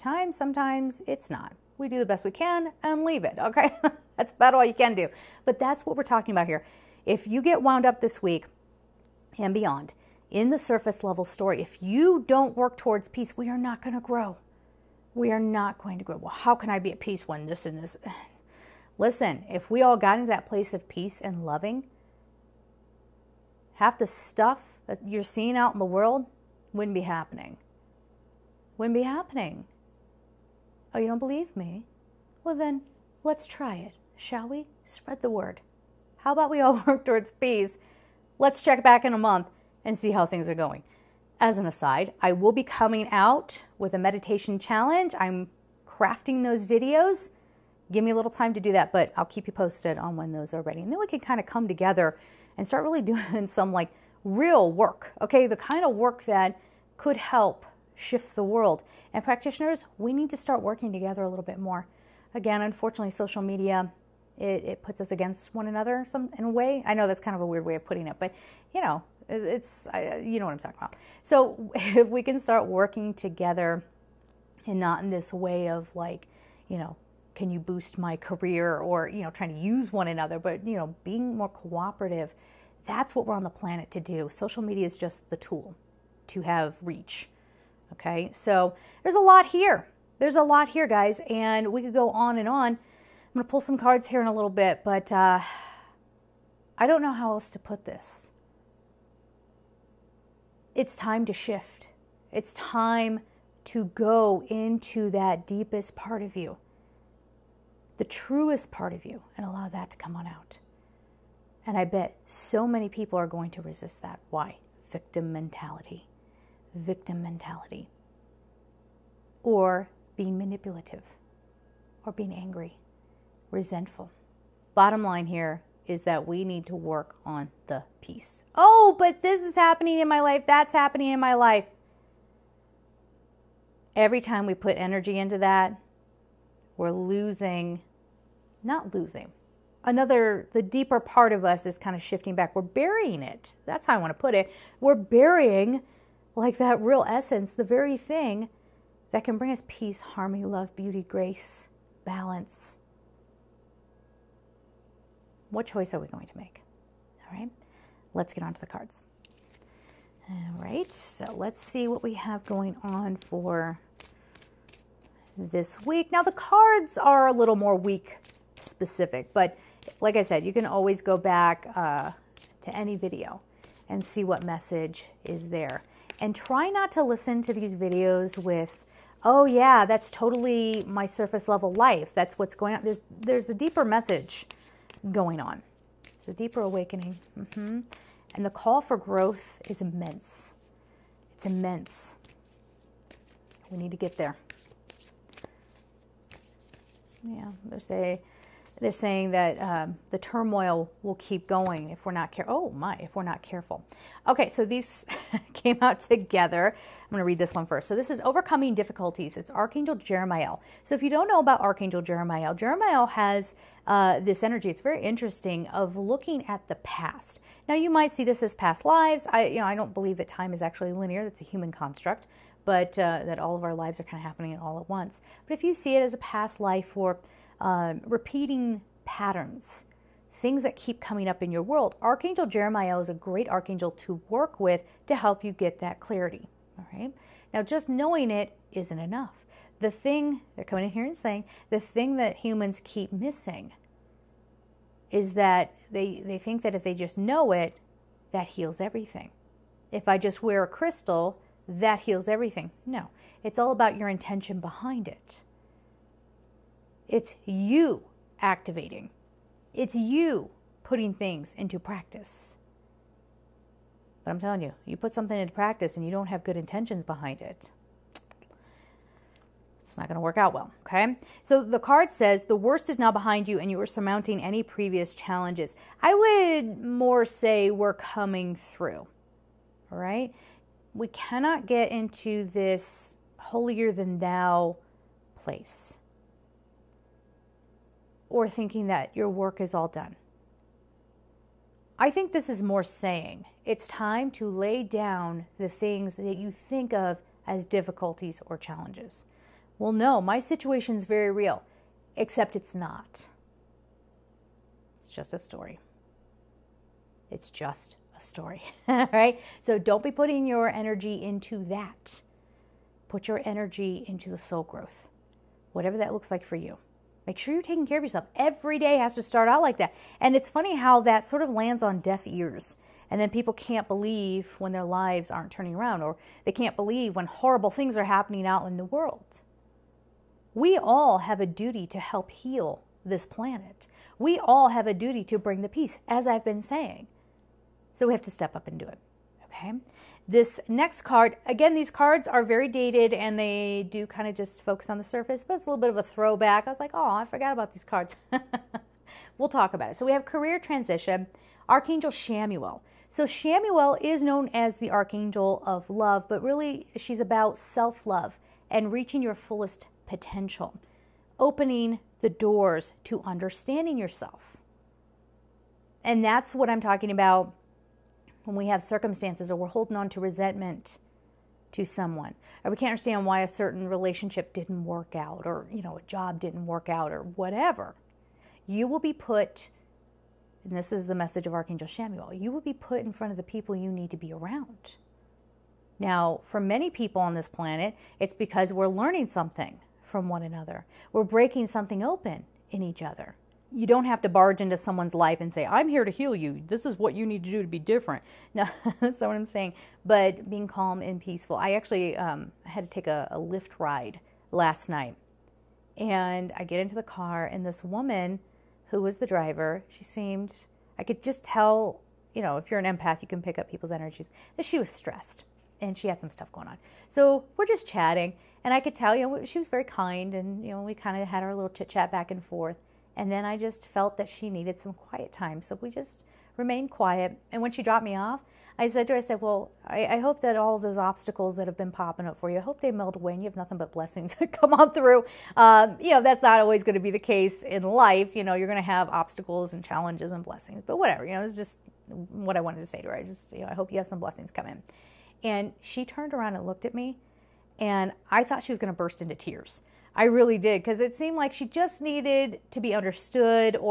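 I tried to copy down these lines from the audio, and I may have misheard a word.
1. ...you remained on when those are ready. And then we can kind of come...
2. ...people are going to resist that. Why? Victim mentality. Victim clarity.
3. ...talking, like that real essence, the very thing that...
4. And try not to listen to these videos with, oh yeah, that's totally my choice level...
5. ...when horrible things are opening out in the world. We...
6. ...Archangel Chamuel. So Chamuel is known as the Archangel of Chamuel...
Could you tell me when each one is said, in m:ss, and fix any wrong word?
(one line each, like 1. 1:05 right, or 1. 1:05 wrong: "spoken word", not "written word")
1. 0:49 wrong: "posted", not "remained"
2. 1:52 wrong: "mentality", not "clarity"
3. 2:24 wrong: "burying", not "talking"
4. 2:56 wrong: "surface", not "choice"
5. 5:27 wrong: "happening", not "opening"
6. 5:51 wrong: "Love", not "Chamuel".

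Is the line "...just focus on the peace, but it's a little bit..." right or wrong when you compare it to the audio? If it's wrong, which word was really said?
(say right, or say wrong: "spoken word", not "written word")
wrong: "surface", not "peace".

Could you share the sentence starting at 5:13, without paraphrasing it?
Put your energy into the soul growth, whatever that looks like for you.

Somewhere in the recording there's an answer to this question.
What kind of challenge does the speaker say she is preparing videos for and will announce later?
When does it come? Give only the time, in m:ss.
0:43.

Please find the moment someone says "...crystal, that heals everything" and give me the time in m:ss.
4:10.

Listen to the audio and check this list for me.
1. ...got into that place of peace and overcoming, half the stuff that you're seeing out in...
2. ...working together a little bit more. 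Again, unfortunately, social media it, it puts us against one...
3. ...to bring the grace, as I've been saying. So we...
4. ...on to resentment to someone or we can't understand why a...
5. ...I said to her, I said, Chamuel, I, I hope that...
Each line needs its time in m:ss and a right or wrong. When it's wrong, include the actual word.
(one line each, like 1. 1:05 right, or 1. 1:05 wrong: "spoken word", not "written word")
1. 0:19 wrong: "loving", not "overcoming"
2. 1:00 right
3. 5:35 wrong: "peace", not "grace"
4. 6:09 right
5. 7:08 wrong: "Well", not "Chamuel".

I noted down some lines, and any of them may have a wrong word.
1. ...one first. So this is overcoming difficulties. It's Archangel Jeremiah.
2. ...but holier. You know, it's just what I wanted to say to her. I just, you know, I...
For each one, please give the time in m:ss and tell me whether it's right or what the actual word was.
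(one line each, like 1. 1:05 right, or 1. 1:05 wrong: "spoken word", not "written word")
1. 3:27 right
2. 7:20 wrong: "whatever", not "holier".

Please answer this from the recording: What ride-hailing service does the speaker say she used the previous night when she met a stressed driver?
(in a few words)
Lyft.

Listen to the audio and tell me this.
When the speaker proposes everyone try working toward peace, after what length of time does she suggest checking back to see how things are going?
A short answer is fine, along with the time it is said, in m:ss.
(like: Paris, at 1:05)
a month, at 0:39.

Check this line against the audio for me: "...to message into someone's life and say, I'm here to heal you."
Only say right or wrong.
wrong.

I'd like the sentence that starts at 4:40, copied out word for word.
We cannot get into this holier than thou place or thinking that your work is all done.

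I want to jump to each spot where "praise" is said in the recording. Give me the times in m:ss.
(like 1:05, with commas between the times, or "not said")
not said.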